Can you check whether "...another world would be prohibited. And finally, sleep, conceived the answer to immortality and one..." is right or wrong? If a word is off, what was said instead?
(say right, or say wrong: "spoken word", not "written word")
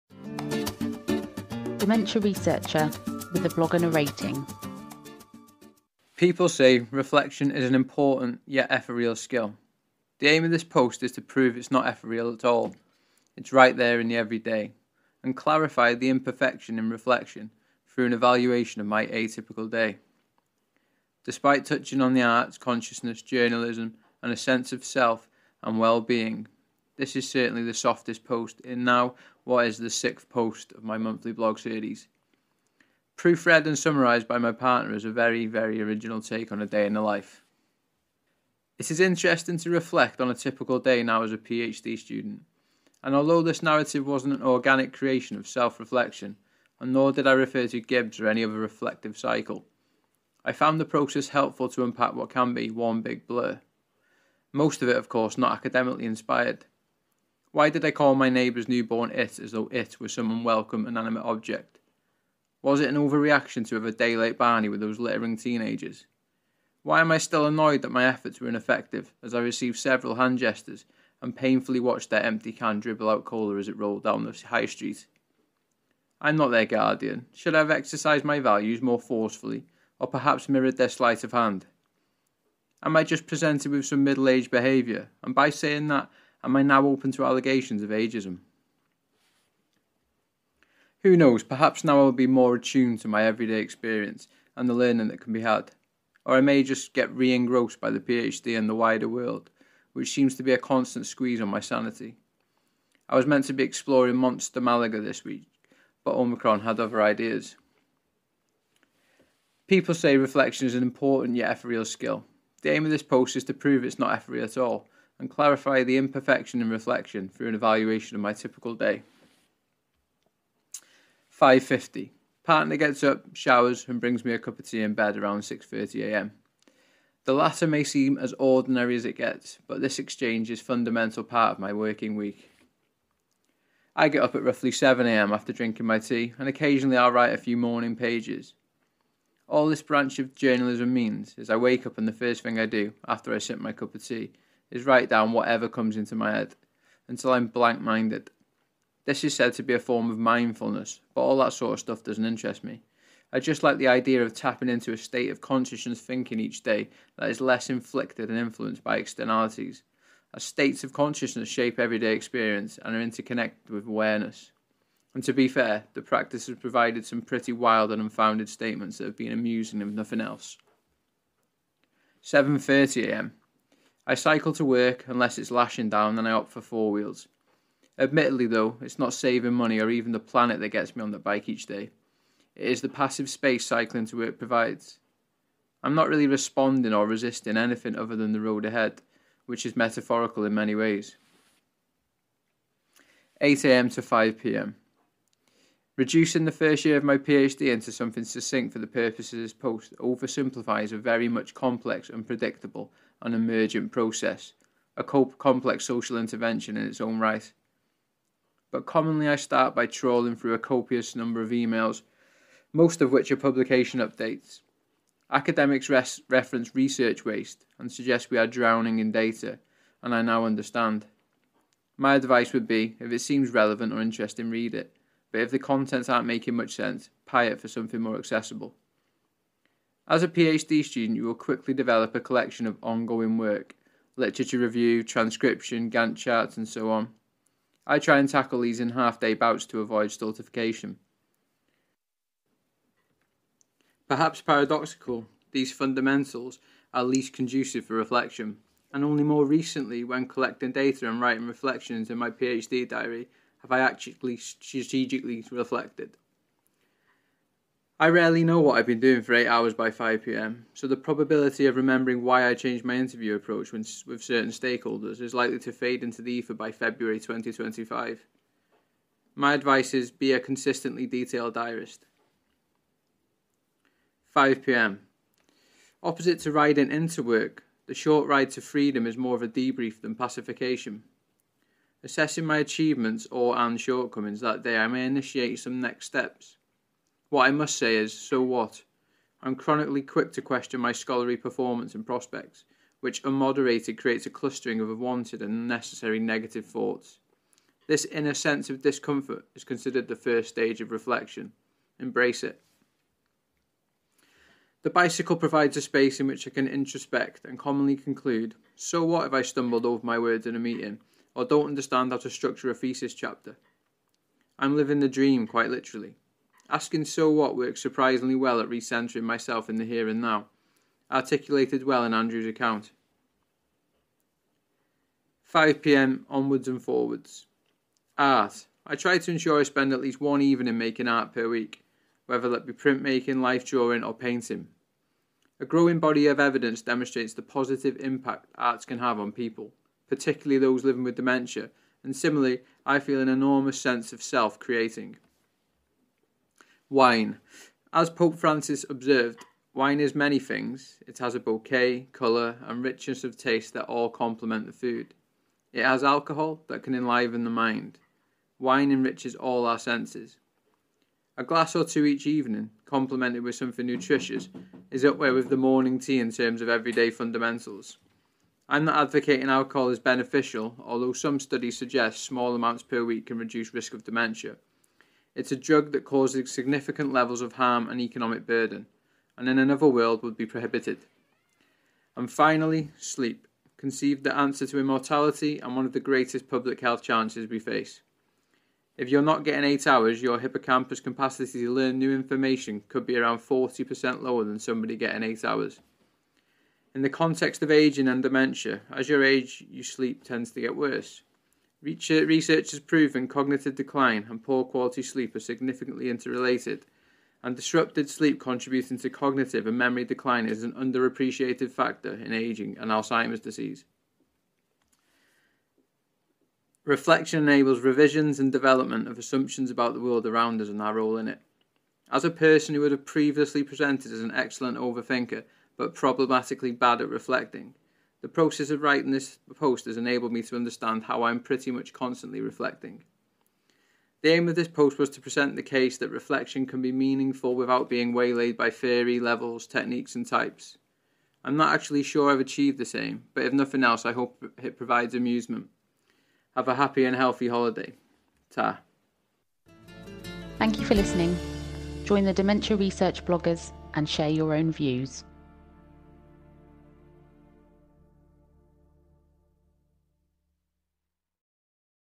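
right.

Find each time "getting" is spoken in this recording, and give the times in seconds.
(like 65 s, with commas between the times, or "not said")
389 s, 394 s.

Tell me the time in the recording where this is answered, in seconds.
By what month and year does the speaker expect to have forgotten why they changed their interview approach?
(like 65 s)
266 s.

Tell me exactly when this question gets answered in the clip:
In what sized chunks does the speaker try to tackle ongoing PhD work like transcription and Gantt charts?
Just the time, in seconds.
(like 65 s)
238 s.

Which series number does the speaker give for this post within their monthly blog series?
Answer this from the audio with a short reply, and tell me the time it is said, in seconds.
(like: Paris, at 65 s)
sixth, at 29 s.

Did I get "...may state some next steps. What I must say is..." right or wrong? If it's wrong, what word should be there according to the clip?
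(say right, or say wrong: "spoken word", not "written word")
wrong: "initiate", not "state".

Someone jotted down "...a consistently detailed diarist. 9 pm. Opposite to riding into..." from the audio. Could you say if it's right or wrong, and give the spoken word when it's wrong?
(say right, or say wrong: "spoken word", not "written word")
wrong: "5", not "9".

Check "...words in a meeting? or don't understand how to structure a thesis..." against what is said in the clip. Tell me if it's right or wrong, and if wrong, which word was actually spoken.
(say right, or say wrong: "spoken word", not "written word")
right.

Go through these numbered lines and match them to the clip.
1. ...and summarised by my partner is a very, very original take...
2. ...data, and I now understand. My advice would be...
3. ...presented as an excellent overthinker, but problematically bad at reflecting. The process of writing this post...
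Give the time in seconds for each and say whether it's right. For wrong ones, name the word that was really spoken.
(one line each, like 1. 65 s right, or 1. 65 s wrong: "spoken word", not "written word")
1. 33 s right
2. 219 s right
3. 423 s right.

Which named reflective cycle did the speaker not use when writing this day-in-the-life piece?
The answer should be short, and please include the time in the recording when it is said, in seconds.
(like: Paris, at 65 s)
Gibbs, at 47 s.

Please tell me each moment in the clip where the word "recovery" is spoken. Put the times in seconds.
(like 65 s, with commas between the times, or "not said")
not said.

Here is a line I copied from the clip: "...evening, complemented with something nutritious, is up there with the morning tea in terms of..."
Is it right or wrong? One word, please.
right.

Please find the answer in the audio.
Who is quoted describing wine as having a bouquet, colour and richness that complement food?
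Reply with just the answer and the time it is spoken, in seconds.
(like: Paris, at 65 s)
Pope Francis, at 348 s.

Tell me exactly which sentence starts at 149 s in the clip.
This is said to be a form of mindfulness, but all that sort of stuff doesn't interest me.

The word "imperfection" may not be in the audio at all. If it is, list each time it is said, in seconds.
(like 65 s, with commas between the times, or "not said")
16 s, 115 s.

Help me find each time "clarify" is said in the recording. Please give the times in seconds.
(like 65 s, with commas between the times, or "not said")
15 s, 115 s.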